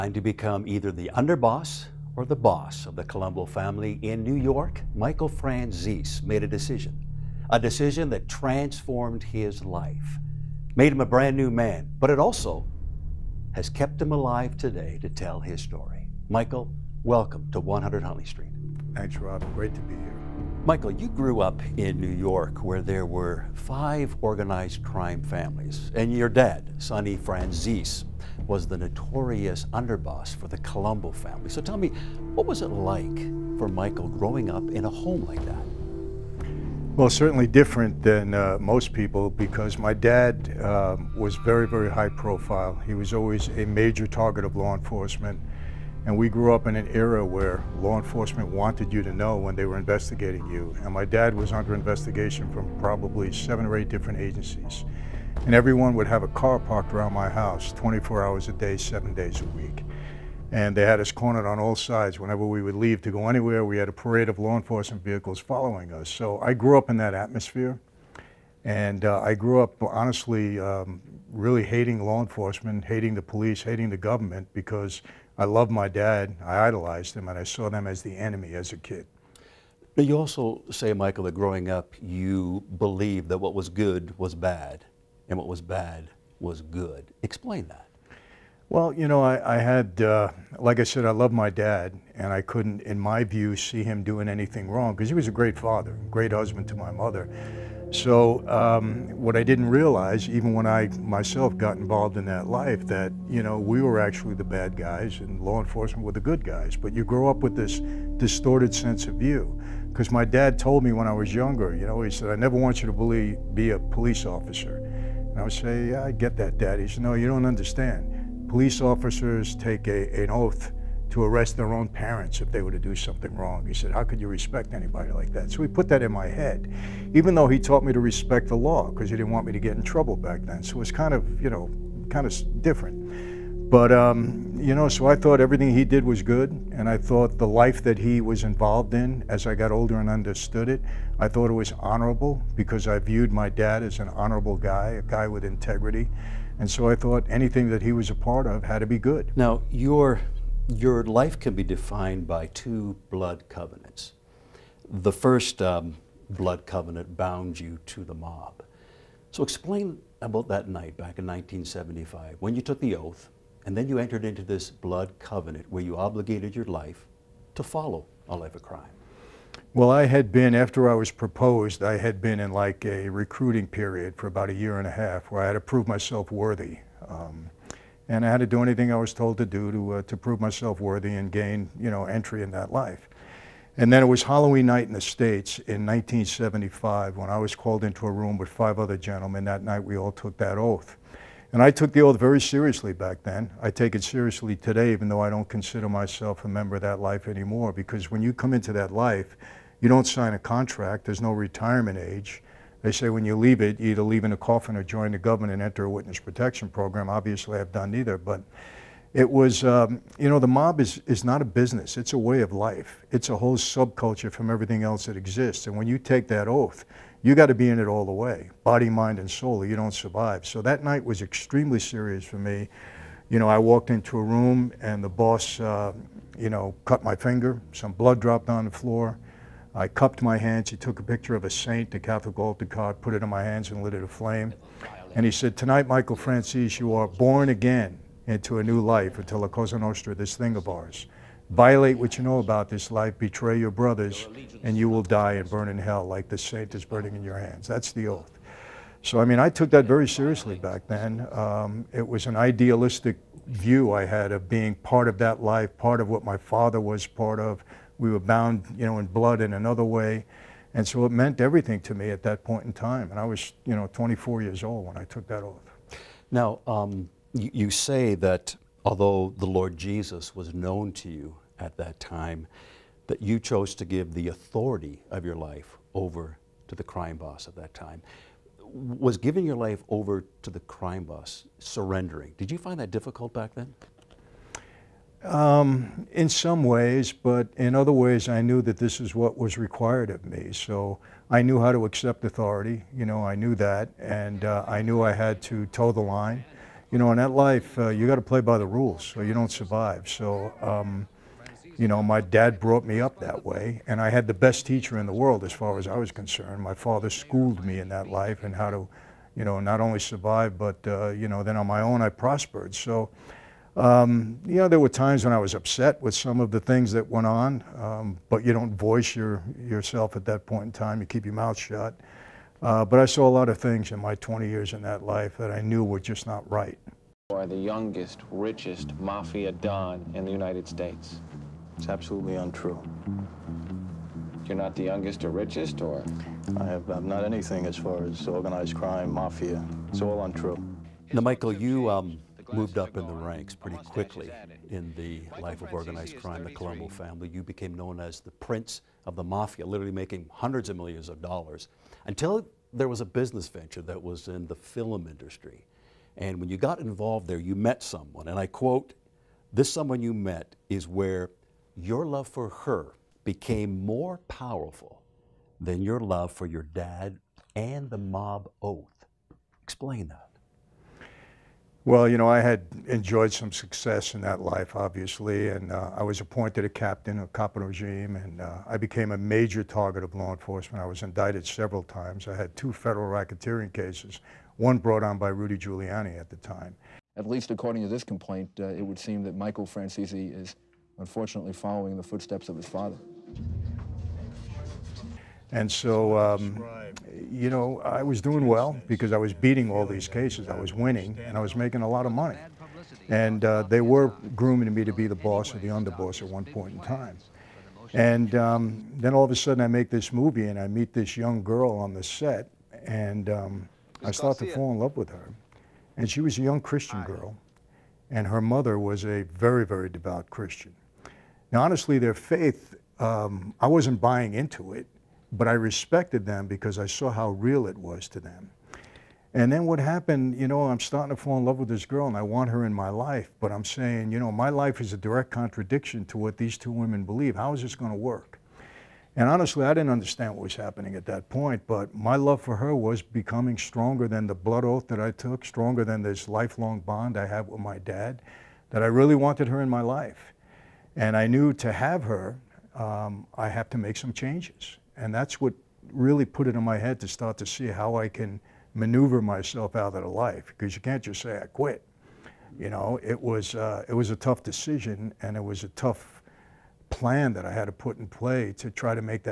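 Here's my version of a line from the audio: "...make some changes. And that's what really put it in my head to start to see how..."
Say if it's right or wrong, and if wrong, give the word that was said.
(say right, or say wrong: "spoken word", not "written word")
right.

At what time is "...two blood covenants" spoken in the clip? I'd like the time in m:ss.
2:32.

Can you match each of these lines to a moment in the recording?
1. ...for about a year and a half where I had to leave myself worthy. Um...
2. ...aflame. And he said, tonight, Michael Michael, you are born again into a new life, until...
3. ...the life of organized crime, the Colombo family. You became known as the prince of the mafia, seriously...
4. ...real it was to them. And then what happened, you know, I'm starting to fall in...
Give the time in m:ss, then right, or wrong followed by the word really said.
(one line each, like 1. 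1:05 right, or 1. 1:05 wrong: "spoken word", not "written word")
1. 2:54 wrong: "prove", not "leave"
2. 3:54 wrong: "Franzese", not "Michael"
3. 5:44 wrong: "literally", not "seriously"
4. 7:07 right.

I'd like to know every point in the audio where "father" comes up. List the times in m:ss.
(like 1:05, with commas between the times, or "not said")
1:35, 4:16, 5:06, 6:32.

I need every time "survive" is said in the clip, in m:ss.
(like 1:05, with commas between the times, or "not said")
3:39, 4:59, 5:09.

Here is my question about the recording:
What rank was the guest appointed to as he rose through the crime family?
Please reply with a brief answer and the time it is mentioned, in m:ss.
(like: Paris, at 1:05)
captain, at 6:16.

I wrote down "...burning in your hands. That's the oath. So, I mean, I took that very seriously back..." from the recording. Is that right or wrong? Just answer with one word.
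right.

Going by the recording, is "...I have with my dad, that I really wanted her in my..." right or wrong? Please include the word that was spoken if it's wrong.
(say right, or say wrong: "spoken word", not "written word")
right.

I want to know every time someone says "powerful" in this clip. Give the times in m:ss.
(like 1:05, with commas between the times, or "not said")
6:04.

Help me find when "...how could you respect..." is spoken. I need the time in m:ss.
2:03.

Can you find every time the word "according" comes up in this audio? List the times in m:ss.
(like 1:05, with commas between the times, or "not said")
6:27.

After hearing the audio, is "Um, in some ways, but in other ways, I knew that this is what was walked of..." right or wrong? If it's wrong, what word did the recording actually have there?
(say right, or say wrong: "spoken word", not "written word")
wrong: "required", not "walked".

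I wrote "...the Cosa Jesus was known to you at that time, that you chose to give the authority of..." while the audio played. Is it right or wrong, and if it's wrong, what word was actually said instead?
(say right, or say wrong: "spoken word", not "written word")
wrong: "Lord", not "Cosa".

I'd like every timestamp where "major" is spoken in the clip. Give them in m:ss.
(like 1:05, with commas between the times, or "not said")
0:43, 6:19.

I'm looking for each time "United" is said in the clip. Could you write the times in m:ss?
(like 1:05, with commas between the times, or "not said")
5:30.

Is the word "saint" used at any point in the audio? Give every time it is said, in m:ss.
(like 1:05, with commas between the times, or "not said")
3:51, 4:06.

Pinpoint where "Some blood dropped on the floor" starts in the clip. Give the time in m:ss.
3:47.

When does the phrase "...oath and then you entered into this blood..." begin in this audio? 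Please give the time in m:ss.
2:42.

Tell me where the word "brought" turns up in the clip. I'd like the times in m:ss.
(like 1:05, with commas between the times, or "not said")
5:02, 6:24.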